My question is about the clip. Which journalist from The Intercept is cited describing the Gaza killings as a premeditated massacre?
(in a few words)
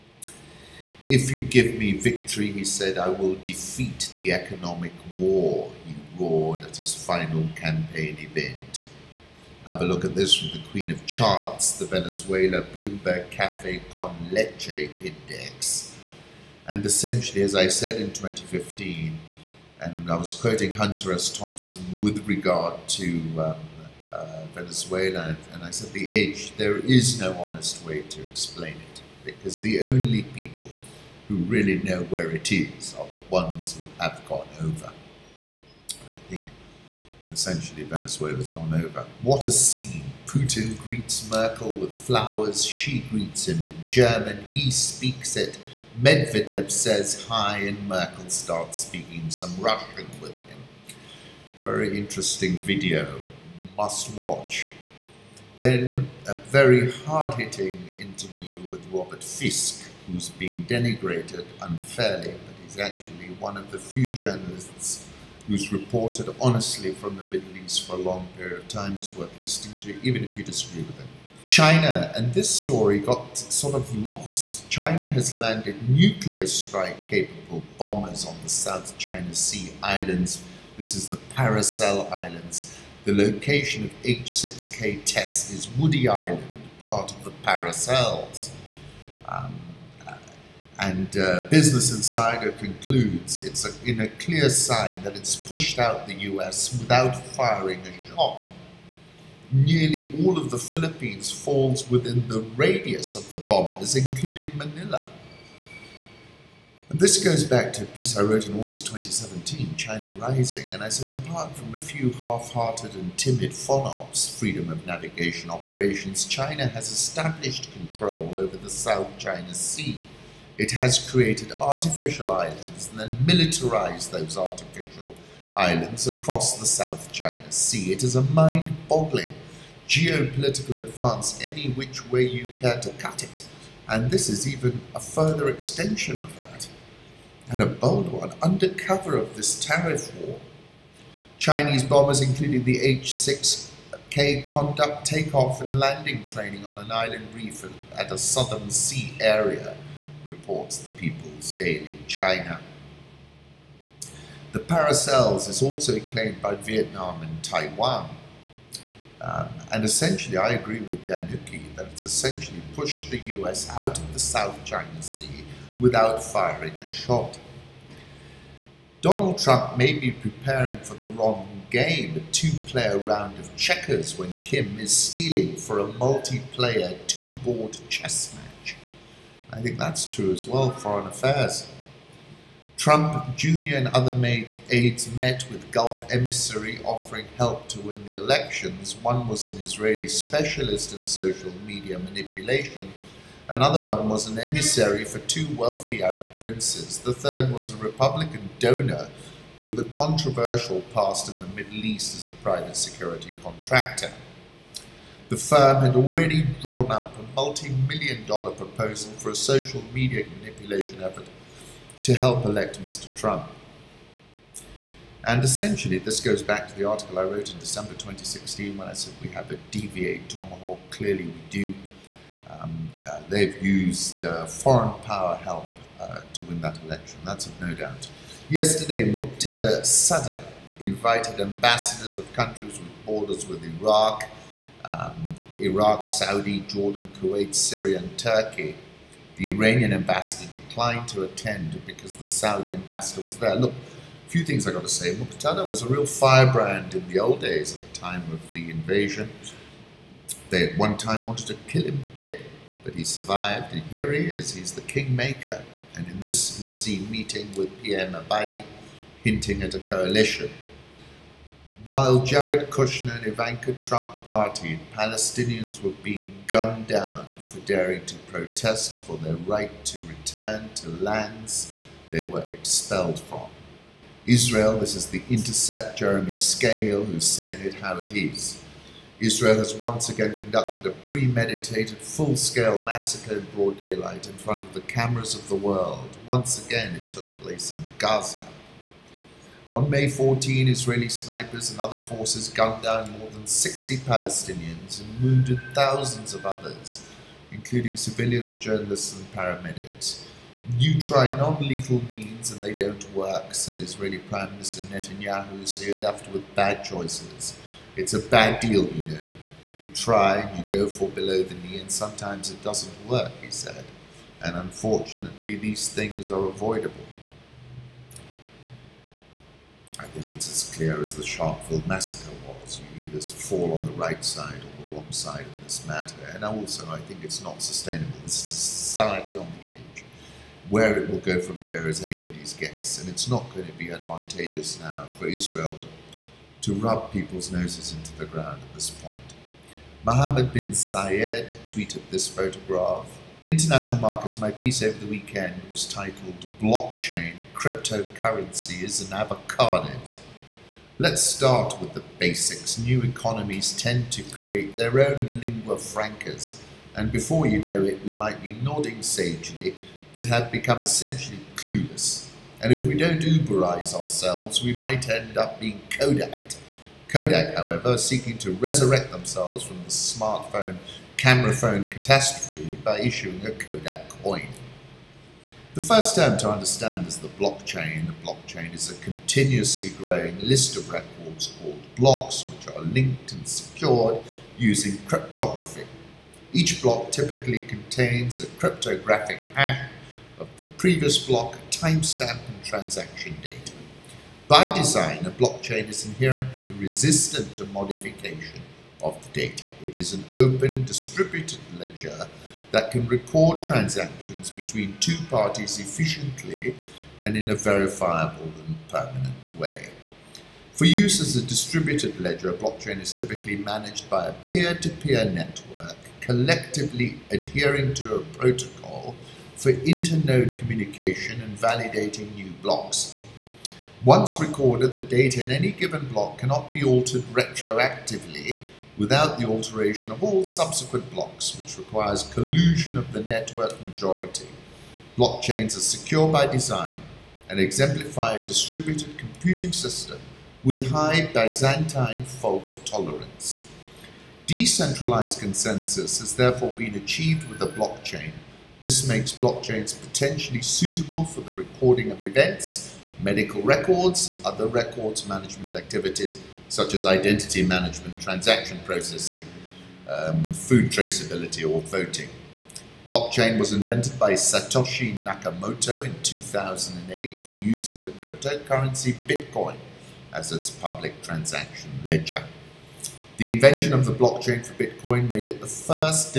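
Jeremy Scahill.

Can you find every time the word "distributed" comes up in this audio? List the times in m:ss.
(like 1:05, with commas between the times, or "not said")
6:40, 6:51, 7:18.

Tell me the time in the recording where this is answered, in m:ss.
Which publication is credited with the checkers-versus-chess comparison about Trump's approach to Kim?
3:00.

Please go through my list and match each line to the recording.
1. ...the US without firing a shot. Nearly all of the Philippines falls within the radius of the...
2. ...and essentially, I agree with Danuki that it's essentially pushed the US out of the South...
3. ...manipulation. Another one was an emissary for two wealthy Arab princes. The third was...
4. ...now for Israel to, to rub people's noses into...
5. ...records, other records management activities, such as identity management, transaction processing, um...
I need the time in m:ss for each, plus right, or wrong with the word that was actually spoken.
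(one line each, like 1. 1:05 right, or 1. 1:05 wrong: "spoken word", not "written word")
1. 1:36 right
2. 2:39 right
3. 3:11 right
4. 5:34 right
5. 7:33 right.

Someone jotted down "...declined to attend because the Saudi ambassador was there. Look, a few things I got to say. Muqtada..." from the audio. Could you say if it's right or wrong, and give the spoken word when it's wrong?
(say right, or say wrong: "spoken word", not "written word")
right.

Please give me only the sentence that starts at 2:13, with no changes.
And this is even a further extension of that.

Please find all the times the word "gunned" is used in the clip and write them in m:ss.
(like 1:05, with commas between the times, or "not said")
4:26, 4:52.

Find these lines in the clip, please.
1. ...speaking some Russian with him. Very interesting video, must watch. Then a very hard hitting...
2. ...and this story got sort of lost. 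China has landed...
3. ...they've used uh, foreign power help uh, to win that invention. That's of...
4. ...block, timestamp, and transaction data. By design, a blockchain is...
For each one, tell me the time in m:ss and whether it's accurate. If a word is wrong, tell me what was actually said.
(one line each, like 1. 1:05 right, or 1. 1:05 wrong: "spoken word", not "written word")
1. 0:48 right
2. 1:12 right
3. 3:43 wrong: "election", not "invention"
4. 6:31 right.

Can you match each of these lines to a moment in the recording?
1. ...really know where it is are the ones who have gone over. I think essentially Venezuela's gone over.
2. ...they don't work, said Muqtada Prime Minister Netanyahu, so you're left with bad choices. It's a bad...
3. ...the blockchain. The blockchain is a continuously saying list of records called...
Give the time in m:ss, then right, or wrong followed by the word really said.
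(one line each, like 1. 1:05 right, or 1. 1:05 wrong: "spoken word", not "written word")
1. 0:31 right
2. 5:02 wrong: "Israeli", not "Muqtada"
3. 6:17 wrong: "growing", not "saying".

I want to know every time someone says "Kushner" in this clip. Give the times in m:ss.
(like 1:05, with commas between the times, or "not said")
4:22.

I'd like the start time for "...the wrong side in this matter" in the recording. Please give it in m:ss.
5:24.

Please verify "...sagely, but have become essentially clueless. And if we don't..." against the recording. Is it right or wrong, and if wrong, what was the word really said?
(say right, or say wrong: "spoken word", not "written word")
right.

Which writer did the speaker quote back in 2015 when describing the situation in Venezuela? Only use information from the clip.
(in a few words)
Hunter S. Thompson.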